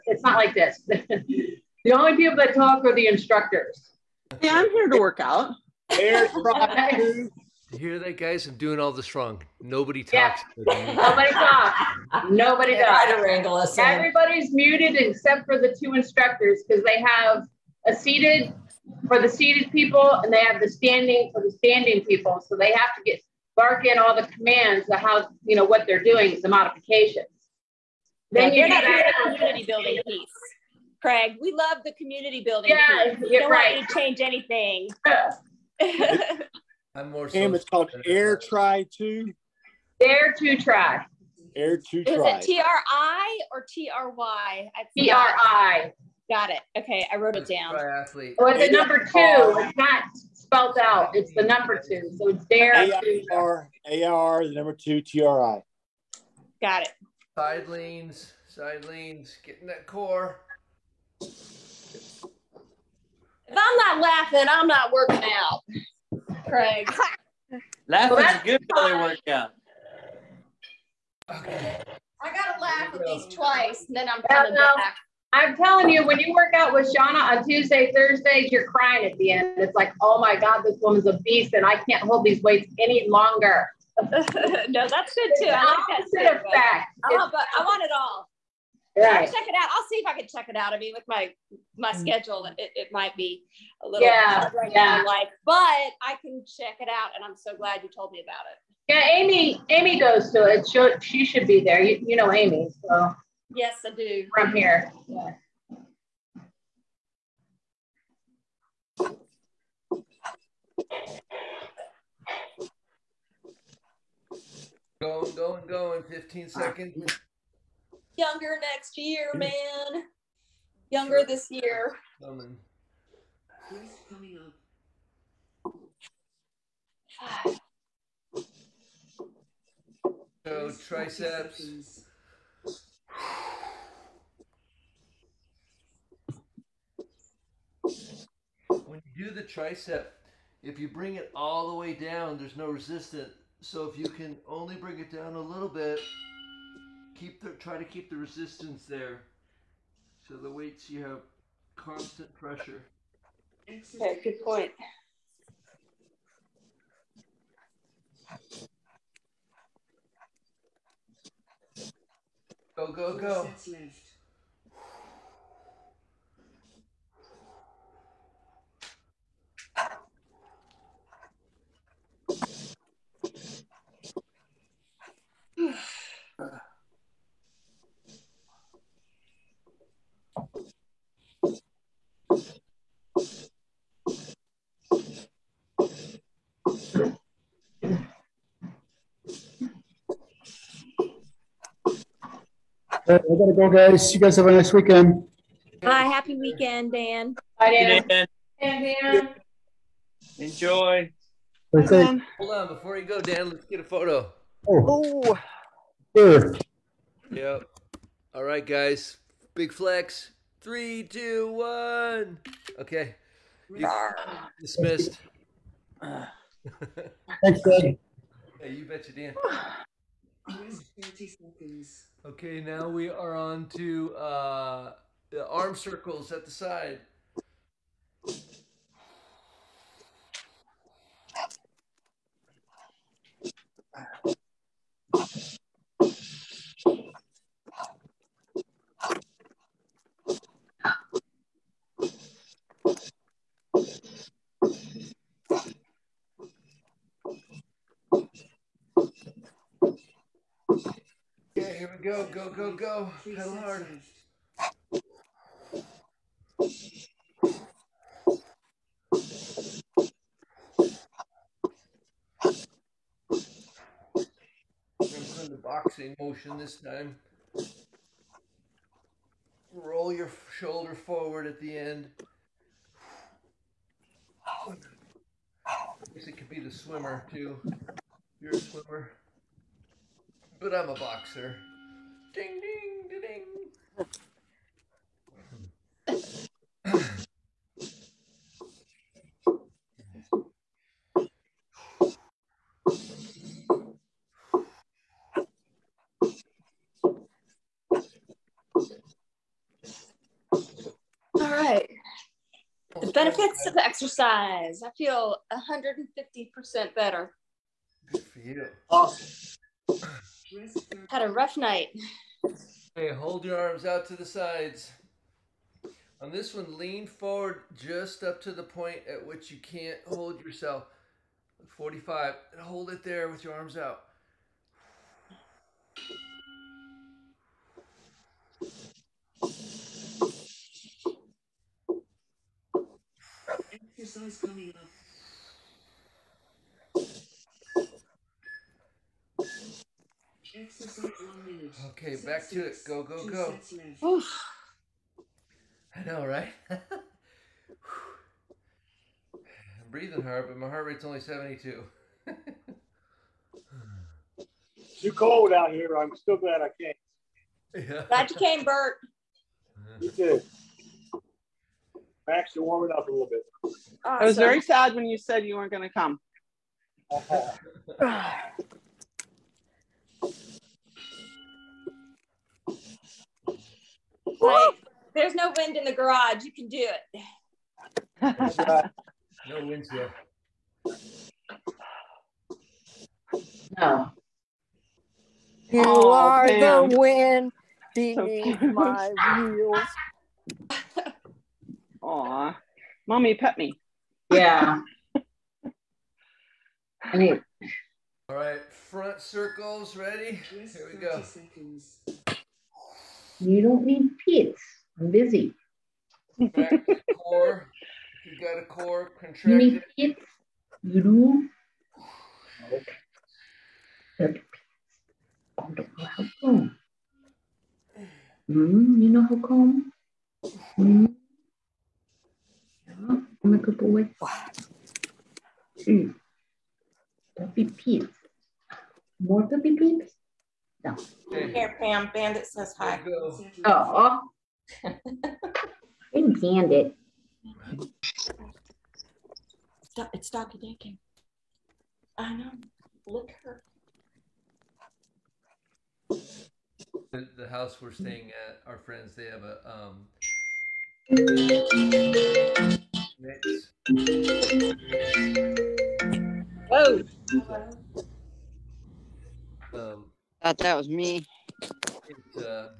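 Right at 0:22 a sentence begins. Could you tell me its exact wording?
So they have to get bark in all the commands of how you know what they're doing, the modifications.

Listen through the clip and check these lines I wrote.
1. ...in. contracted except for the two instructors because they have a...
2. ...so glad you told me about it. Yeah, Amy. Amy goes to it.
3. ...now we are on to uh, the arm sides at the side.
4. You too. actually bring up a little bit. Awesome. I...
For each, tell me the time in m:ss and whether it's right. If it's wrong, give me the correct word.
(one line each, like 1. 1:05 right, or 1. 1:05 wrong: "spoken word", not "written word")
1. 0:14 wrong: "muted", not "contracted"
2. 1:37 right
3. 3:42 wrong: "circles", not "sides"
4. 6:00 wrong: "warming", not "bring".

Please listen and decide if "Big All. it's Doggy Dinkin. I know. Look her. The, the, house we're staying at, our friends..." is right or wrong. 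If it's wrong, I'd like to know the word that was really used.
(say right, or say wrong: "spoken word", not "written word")
wrong: "Bandit", not "All".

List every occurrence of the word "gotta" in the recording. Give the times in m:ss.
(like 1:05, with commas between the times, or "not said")
1:12, 3:13.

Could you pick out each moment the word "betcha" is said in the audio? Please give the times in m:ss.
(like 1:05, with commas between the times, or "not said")
3:38.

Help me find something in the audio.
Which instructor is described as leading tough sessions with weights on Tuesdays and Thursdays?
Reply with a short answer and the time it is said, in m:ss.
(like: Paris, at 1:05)
Shauna, at 1:16.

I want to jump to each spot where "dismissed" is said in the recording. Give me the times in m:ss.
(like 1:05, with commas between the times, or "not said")
3:34.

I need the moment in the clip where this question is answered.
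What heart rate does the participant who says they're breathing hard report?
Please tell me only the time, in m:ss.
5:51.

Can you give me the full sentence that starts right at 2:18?
When you do the tricep, if you bring it all the way down, there's no resistance.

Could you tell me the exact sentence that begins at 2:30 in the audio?
So the weights you have constant pressure.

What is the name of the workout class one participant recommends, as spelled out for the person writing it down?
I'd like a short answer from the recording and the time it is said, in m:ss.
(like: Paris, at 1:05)
Air 2 Tri, at 0:38.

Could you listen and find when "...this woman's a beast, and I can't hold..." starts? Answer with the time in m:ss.
1:20.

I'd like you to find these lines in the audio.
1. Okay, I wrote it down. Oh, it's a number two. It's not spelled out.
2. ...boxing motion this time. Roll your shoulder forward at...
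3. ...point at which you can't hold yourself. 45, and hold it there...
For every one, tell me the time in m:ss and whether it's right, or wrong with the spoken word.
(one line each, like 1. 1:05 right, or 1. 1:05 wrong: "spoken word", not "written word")
1. 0:46 right
2. 4:25 right
3. 5:18 right.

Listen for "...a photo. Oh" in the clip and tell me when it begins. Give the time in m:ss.
3:23.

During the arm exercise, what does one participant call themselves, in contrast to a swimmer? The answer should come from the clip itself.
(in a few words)
boxer.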